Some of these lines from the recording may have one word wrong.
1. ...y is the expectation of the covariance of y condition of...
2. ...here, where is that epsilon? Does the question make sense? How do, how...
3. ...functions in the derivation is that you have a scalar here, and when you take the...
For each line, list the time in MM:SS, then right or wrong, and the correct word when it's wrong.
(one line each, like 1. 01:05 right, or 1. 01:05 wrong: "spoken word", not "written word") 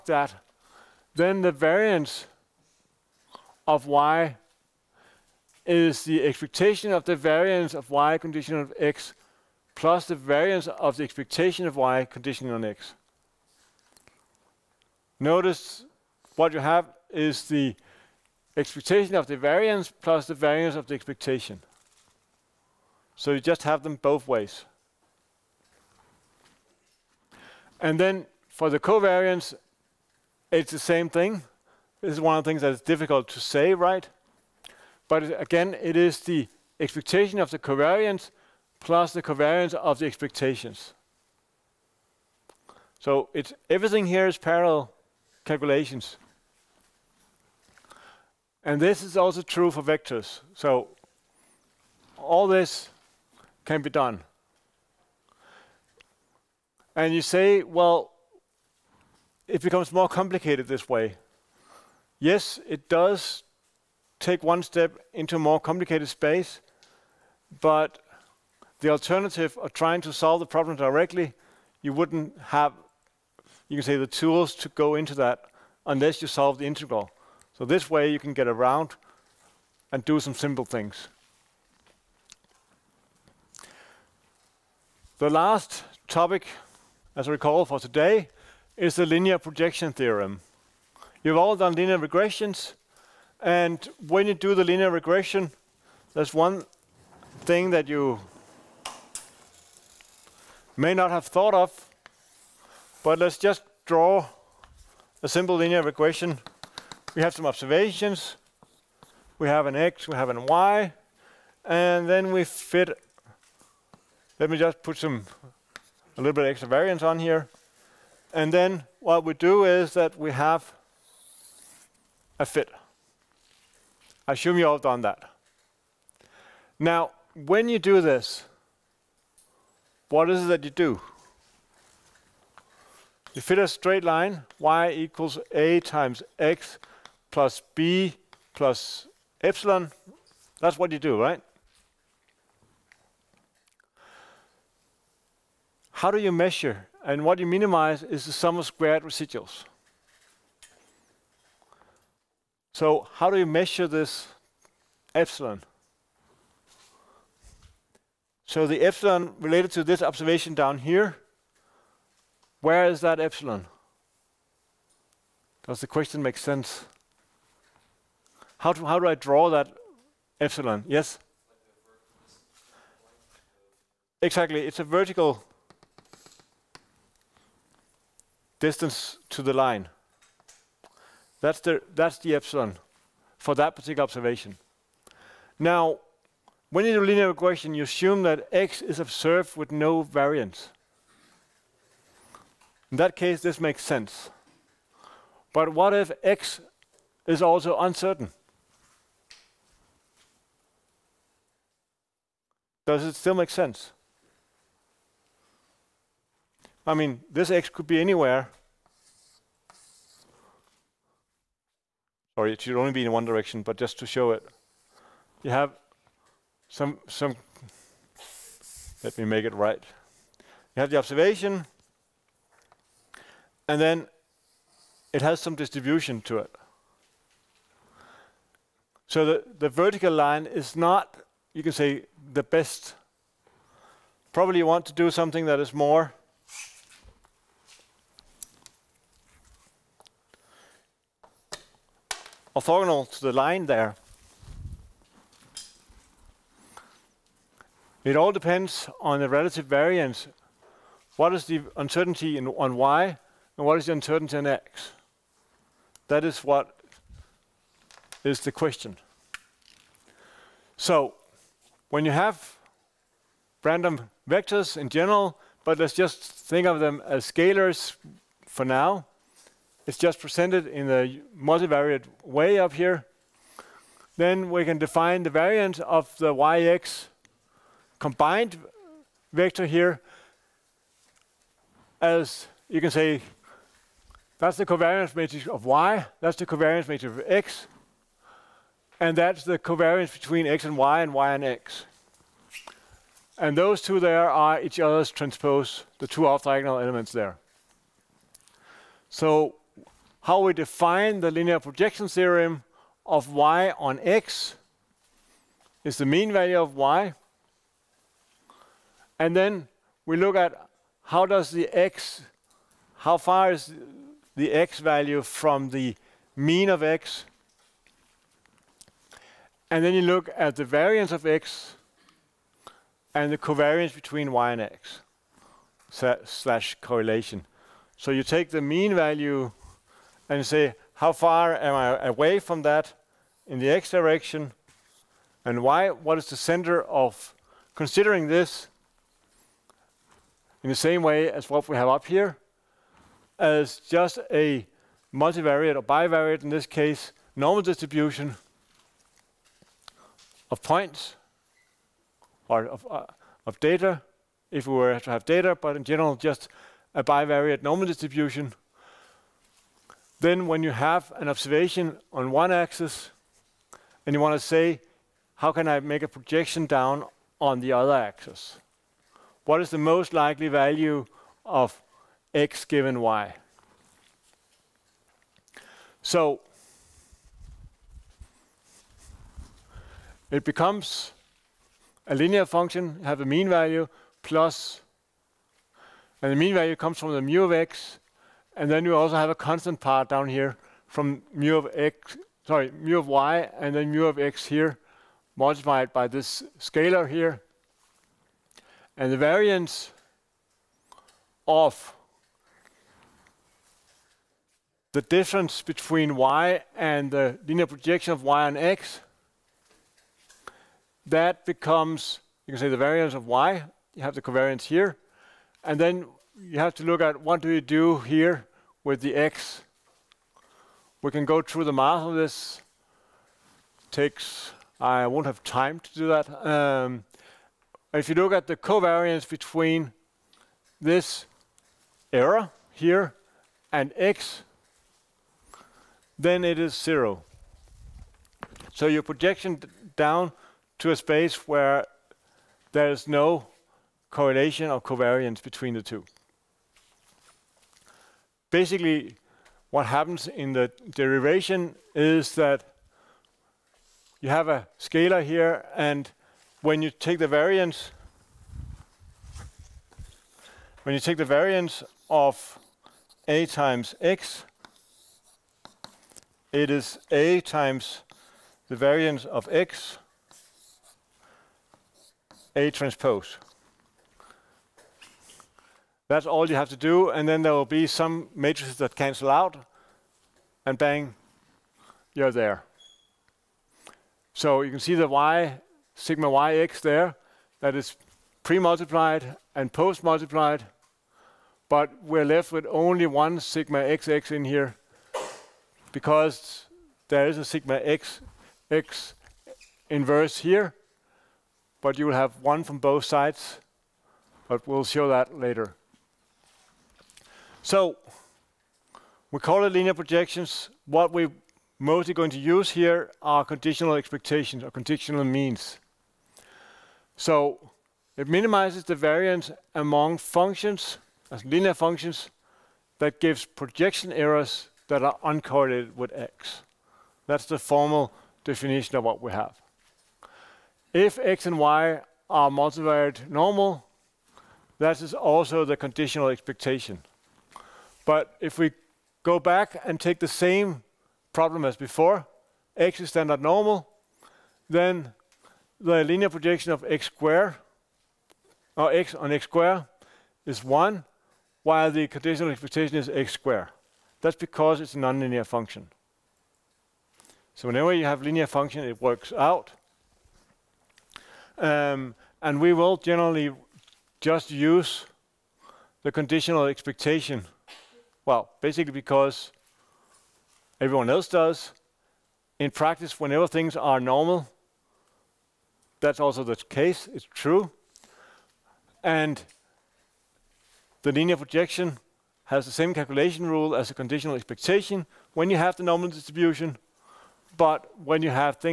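1. 00:03 wrong: "variance", not "covariance"
2. 02:40 right
3. 07:29 wrong: "happens", not "functions".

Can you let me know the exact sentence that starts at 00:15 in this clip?
Notice what you have is the expectation of the variance plus the variance of the expectation.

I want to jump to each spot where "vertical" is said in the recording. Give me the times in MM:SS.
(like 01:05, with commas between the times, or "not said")
02:54, 03:49.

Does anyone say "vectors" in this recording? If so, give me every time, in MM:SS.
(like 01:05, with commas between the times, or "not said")
00:49, 04:24, 04:39.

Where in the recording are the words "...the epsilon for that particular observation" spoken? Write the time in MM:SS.
03:02.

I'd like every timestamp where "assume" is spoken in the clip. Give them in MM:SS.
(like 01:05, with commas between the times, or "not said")
02:04, 03:07.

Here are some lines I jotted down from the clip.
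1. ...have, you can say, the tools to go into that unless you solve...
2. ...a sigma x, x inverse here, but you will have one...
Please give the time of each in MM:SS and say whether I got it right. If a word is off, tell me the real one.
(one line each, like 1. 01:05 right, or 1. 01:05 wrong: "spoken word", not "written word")
1. 01:12 right
2. 08:17 right.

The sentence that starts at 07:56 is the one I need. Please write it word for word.
That's all you have to do, and then there will be some matrices that cancel out, and bang, you're there.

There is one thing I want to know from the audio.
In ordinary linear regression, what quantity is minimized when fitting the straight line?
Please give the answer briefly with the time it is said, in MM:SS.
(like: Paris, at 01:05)
Sum of squared residuals, at 02:28.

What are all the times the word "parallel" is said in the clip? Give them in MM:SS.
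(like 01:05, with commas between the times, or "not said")
00:44.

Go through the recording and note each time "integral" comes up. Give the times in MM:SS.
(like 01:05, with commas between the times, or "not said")
01:16.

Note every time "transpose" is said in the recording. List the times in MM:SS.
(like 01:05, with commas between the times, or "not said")
04:55, 07:52.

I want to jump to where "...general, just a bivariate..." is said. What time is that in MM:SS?
05:55.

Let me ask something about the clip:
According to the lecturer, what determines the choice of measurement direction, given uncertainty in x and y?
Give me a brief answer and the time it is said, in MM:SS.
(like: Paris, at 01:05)
Relative variance, at 04:09.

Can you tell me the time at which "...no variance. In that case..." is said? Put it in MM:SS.
03:09.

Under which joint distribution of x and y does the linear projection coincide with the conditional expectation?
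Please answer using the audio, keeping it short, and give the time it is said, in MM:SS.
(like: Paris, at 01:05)
Multivariate normal, at 08:52.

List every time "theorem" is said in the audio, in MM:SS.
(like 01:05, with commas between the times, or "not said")
01:29, 05:02.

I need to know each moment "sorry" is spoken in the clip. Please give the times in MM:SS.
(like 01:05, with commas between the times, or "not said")
03:32, 06:32.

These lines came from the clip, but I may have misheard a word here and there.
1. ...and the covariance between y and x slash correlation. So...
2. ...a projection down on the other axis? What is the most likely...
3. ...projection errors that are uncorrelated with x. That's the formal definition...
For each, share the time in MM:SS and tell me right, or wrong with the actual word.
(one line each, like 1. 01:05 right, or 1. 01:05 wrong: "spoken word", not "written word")
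1. 05:23 right
2. 06:06 right
3. 08:43 right.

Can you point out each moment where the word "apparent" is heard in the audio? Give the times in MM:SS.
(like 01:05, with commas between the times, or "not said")
not said.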